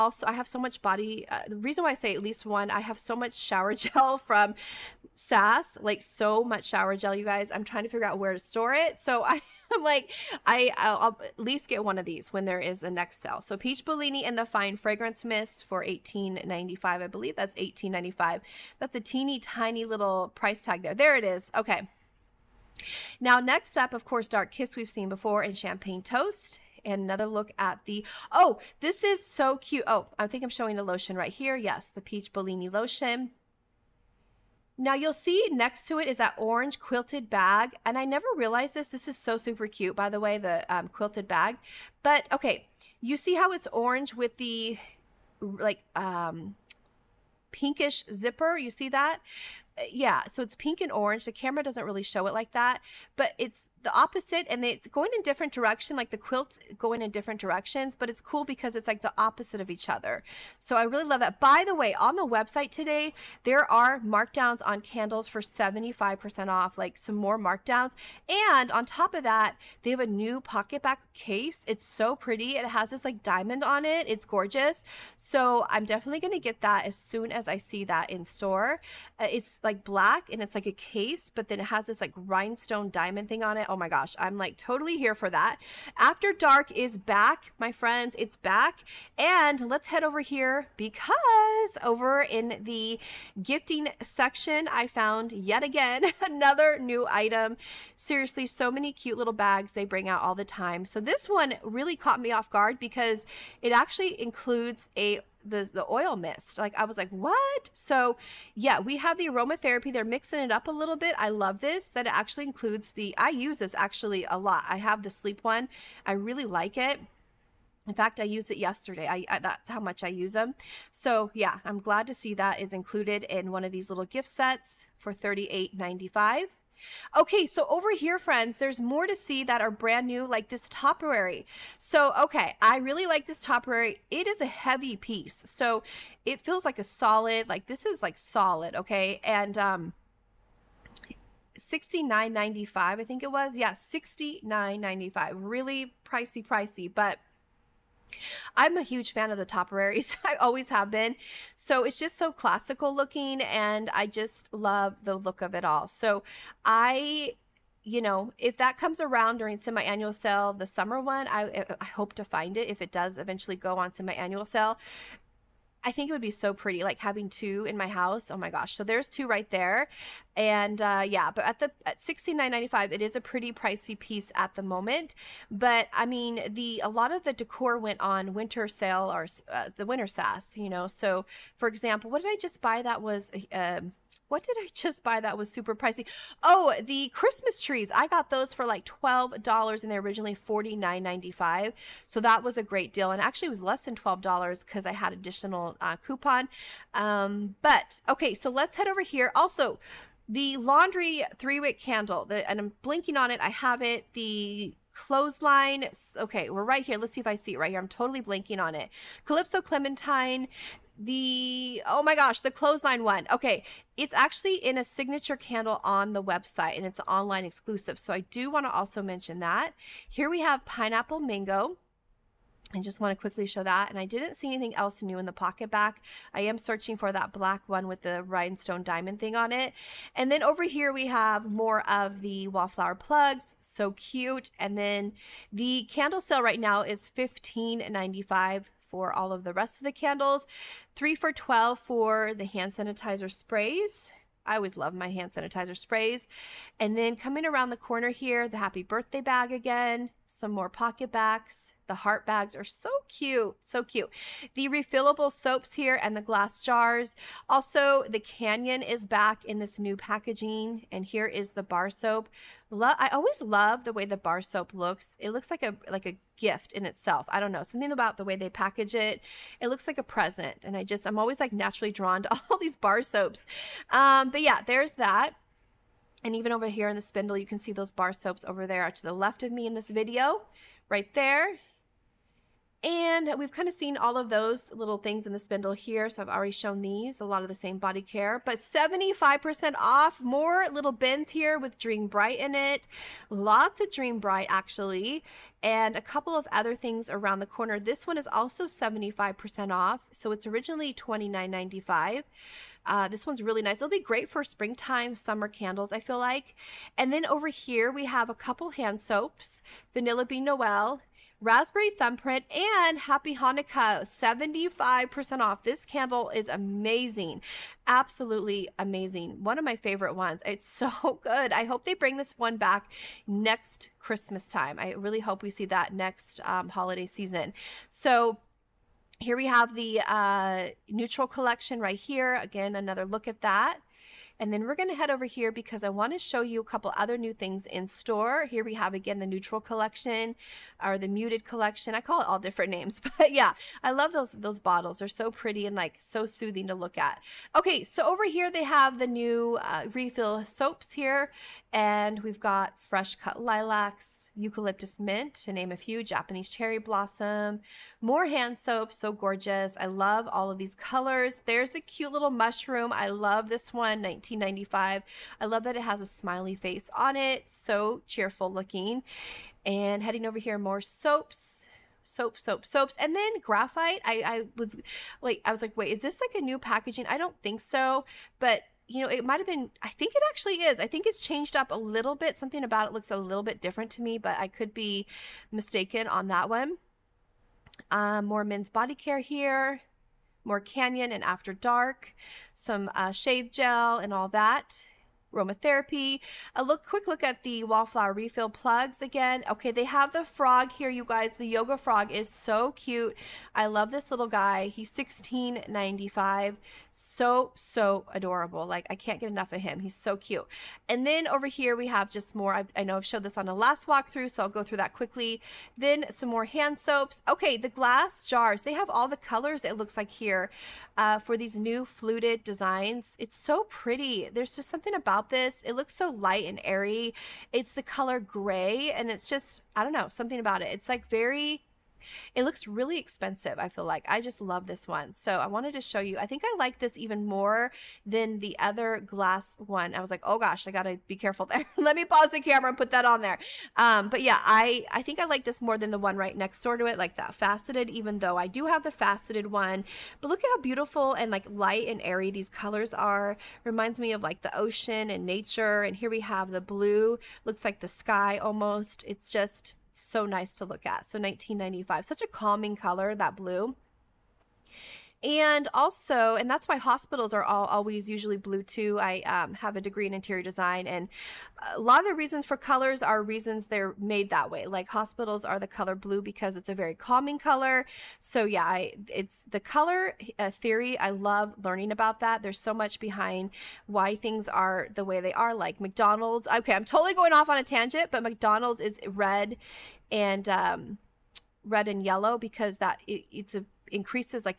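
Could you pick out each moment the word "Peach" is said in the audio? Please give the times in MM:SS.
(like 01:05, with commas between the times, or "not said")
00:13, 00:32.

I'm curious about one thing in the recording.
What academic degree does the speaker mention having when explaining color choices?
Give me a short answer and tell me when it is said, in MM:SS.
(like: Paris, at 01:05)
Interior design, at 07:50.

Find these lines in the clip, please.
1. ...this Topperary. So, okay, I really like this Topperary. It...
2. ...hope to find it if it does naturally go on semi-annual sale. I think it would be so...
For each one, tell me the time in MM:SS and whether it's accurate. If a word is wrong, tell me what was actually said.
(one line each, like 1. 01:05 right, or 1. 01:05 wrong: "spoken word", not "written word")
1. 02:10 right
2. 02:41 wrong: "eventually", not "naturally".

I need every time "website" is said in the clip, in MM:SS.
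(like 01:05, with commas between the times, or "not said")
01:02, 03:36.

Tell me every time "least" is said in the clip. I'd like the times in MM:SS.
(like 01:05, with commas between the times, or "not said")
00:02, 00:11.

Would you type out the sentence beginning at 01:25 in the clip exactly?
After Dark is back, my friends, it's back.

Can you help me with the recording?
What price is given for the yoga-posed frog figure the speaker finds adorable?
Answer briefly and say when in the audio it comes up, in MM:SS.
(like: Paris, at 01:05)
$16.95, at 06:44.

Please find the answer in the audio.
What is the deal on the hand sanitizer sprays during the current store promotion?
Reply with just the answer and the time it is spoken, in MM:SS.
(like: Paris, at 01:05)
3 for $12, at 04:00.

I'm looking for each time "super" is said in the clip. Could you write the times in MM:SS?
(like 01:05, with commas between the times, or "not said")
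00:39, 03:05.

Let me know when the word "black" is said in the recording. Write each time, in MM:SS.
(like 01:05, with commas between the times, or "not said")
01:19, 03:47.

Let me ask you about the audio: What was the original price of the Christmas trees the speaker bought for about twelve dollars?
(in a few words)
$49.95.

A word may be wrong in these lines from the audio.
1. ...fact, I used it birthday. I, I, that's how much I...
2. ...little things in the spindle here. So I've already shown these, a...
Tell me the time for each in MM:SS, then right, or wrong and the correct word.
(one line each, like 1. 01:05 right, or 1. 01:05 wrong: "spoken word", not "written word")
1. 01:57 wrong: "yesterday", not "birthday"
2. 04:44 right.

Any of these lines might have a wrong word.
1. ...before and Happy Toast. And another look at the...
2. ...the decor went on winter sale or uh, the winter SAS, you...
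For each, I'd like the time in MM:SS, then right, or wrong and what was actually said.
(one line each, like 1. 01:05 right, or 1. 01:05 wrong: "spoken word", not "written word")
1. 00:25 wrong: "Champagne", not "Happy"
2. 02:57 right.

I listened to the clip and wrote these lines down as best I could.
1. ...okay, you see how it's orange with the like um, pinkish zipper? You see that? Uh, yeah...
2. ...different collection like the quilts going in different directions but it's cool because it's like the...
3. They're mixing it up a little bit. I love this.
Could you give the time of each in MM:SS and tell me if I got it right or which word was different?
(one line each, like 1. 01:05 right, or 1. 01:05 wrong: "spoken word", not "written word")
1. 00:42 right
2. 00:55 wrong: "direction", not "collection"
3. 01:49 right.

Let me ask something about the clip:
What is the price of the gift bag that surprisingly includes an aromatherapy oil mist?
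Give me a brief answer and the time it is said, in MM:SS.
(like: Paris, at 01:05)
$38.95, at 02:05.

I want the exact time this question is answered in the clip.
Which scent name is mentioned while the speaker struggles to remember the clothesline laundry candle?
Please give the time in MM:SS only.
03:29.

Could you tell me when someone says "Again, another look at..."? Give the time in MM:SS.
05:32.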